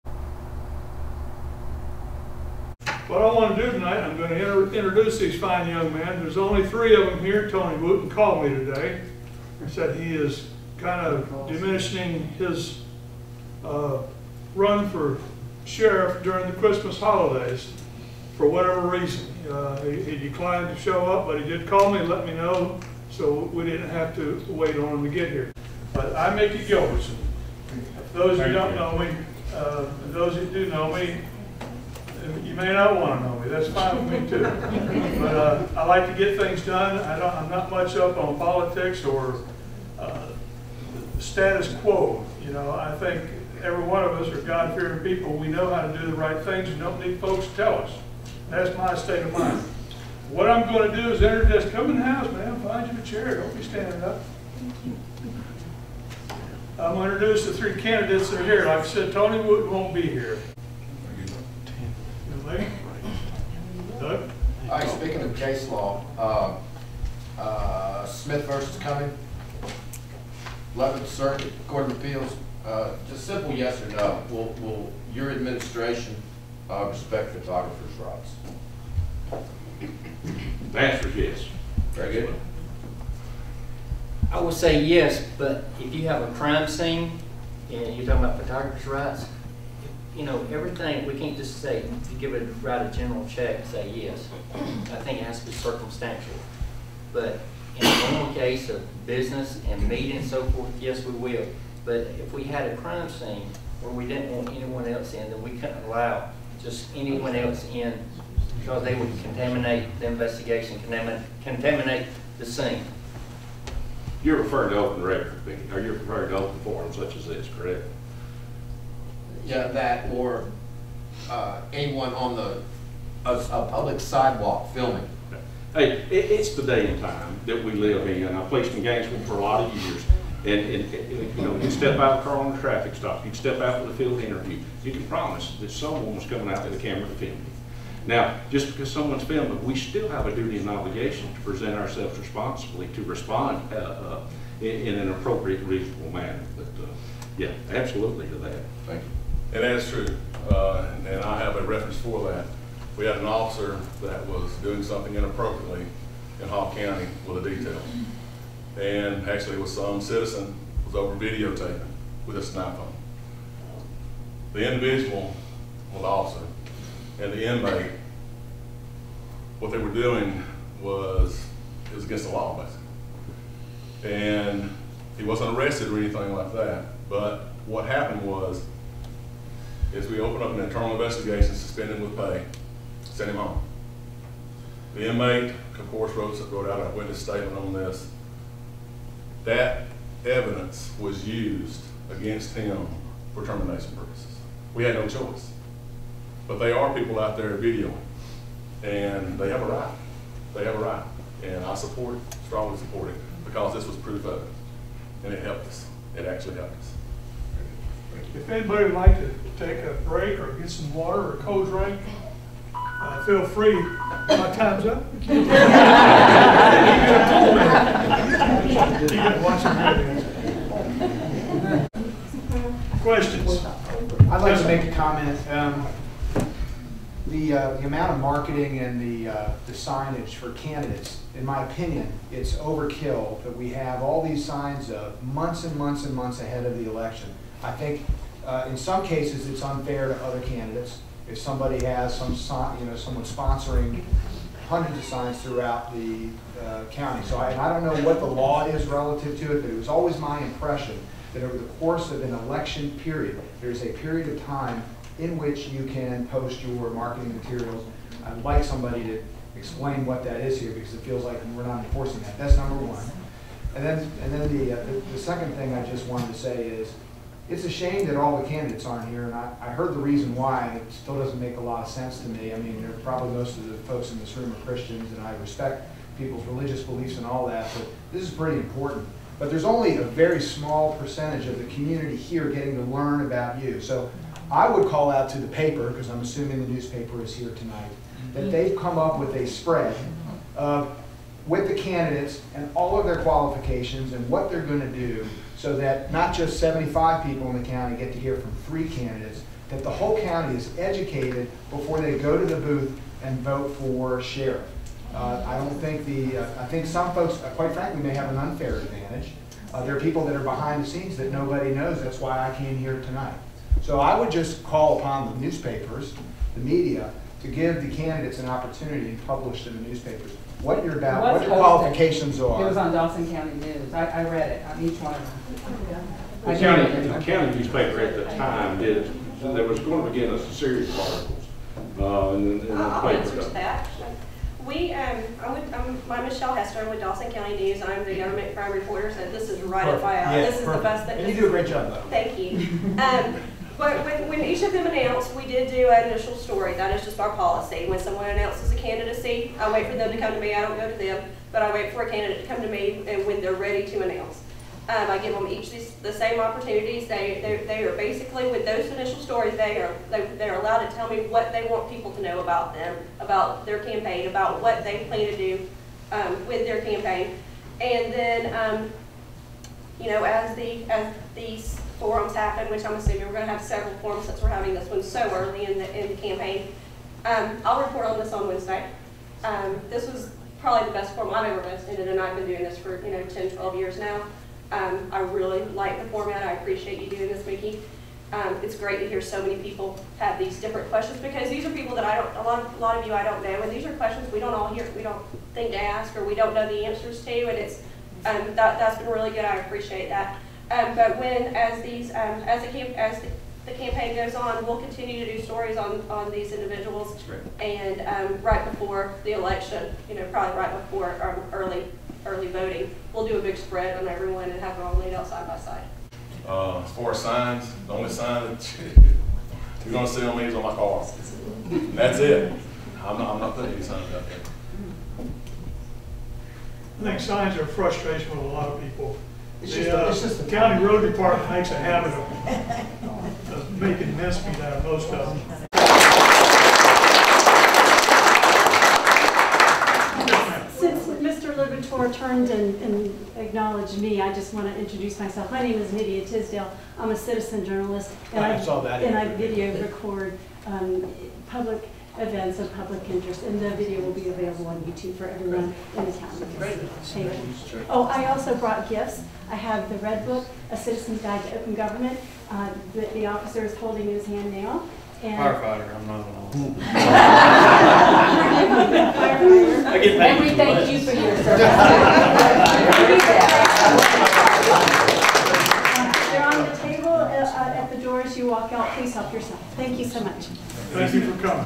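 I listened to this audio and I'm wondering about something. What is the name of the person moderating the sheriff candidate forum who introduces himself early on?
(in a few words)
Mickey Gilbertson.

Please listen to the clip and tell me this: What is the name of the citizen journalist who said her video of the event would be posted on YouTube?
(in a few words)
Nydia Tisdale.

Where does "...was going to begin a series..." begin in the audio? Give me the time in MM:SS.
05:29.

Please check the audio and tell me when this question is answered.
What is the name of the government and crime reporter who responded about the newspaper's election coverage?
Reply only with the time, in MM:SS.
05:36.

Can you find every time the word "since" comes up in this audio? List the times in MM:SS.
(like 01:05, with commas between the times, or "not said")
06:14, 07:20.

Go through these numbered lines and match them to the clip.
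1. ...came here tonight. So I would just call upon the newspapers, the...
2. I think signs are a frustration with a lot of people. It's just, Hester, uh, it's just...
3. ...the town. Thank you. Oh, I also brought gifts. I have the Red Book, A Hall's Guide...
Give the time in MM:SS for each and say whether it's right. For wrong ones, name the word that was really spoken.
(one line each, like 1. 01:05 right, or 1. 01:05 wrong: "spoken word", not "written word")
1. 05:12 right
2. 07:06 wrong: "The", not "Hester"
3. 07:36 wrong: "Citizen", not "Hall".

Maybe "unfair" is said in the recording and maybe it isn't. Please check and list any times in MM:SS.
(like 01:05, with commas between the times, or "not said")
03:59, 05:08.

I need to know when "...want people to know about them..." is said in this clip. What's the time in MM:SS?
06:01.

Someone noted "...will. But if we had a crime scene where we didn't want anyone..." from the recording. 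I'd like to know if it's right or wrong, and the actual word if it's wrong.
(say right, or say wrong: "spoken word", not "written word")
right.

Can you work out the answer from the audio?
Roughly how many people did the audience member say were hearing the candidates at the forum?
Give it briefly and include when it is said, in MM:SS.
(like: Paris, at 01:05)
75, at 04:56.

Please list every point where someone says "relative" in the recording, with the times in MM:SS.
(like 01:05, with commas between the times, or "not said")
04:08.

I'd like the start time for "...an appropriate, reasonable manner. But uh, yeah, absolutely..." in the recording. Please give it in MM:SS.
02:24.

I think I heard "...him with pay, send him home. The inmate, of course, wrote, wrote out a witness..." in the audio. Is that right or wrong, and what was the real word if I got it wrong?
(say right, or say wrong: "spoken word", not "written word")
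right.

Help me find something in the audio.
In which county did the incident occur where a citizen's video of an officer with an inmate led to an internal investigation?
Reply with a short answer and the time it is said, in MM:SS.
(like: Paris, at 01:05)
Hall County, at 02:36.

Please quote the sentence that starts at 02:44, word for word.
The individual, well the officer, and the inmate, what they were doing was, it was against the law basically.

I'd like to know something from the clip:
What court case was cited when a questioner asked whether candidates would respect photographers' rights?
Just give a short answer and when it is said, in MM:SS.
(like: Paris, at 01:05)
Smith versus Cumming, at 01:08.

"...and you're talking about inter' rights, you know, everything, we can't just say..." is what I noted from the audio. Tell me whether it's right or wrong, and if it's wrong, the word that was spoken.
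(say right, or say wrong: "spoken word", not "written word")
wrong: "photographers", not "inter".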